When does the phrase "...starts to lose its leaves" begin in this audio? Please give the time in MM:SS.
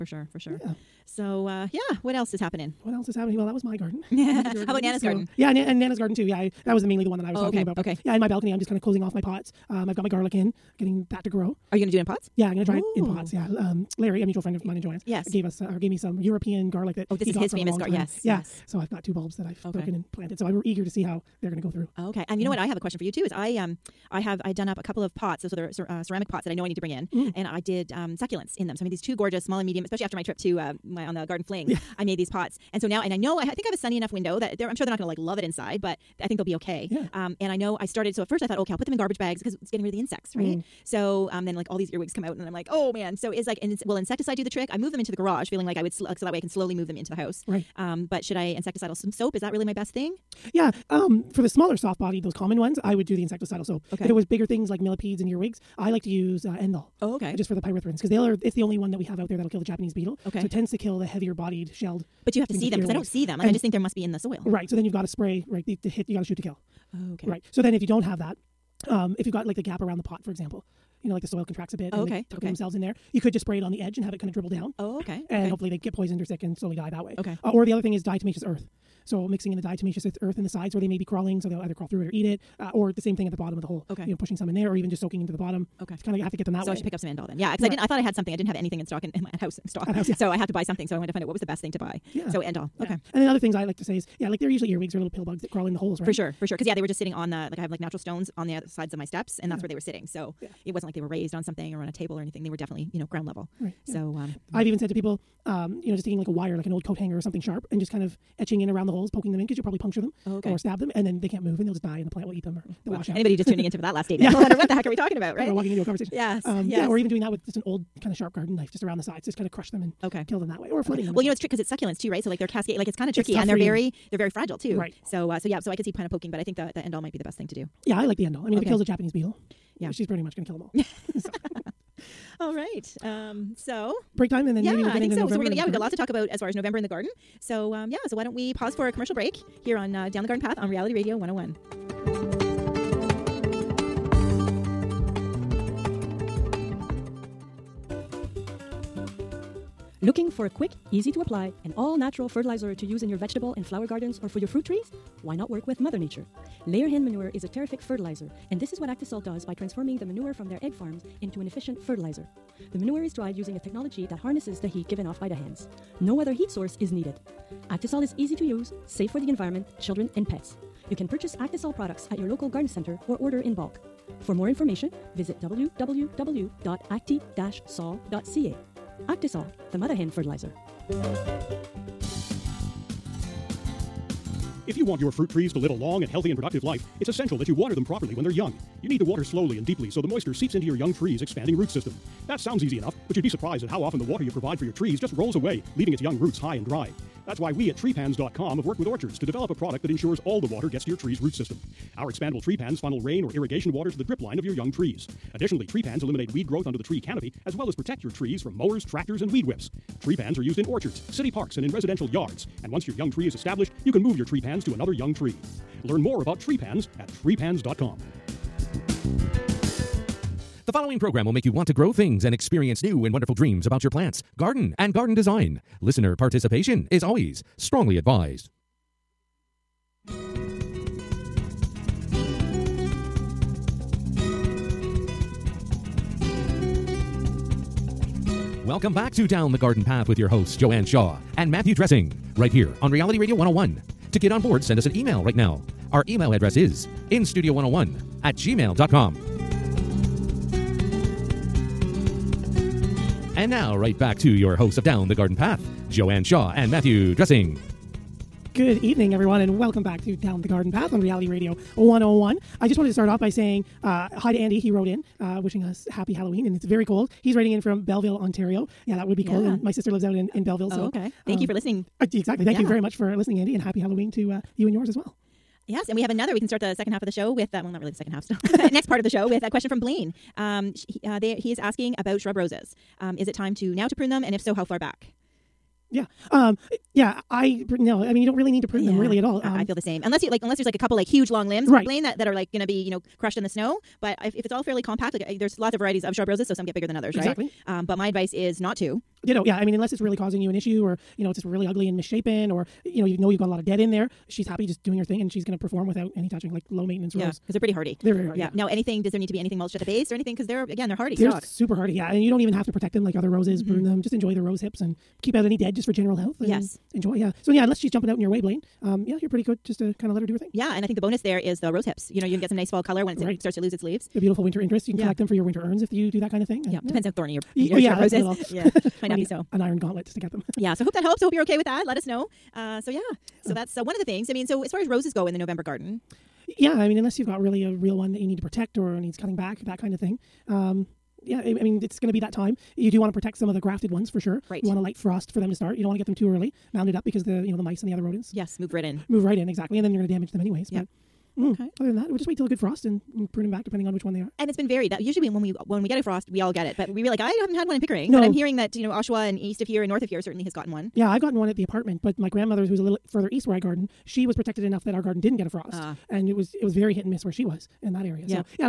05:23.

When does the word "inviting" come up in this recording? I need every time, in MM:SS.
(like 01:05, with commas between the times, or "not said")
not said.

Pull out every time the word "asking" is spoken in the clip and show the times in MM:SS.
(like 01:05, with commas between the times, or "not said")
04:41.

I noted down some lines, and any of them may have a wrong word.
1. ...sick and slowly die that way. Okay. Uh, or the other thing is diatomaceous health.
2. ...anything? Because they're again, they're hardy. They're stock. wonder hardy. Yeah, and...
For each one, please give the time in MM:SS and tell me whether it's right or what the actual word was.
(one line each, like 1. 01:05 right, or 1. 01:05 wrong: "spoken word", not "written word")
1. 01:16 wrong: "earth", not "health"
2. 05:10 wrong: "super", not "wonder".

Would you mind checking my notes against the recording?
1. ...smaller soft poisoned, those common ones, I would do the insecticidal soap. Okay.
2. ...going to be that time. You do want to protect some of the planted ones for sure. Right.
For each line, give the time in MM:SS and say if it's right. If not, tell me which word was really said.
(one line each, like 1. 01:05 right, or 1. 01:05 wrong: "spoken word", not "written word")
1. 00:51 wrong: "bodied", not "poisoned"
2. 05:41 wrong: "grafted", not "planted".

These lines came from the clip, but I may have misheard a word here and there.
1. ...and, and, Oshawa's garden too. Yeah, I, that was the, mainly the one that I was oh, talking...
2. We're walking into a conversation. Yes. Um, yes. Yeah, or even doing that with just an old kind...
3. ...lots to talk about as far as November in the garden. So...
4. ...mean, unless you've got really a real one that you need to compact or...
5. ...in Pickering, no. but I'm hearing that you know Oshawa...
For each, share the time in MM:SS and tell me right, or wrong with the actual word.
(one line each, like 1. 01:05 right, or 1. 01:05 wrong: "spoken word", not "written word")
1. 00:05 wrong: "Nana", not "Oshawa"
2. 01:55 right
3. 02:15 right
4. 05:36 wrong: "protect", not "compact"
5. 05:57 right.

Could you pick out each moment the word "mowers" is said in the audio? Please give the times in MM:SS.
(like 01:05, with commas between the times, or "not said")
03:28.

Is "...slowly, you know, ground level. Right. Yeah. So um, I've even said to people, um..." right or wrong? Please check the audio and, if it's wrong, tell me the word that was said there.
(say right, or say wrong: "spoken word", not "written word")
wrong: "definitely", not "slowly".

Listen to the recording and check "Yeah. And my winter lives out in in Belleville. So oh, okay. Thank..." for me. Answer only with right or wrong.
wrong.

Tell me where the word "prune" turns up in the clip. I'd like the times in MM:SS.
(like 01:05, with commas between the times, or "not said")
04:43, 04:48, 05:13, 05:53.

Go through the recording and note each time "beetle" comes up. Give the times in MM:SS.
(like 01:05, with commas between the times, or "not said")
00:59, 02:09.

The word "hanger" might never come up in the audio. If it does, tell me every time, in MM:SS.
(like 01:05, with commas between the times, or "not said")
01:46.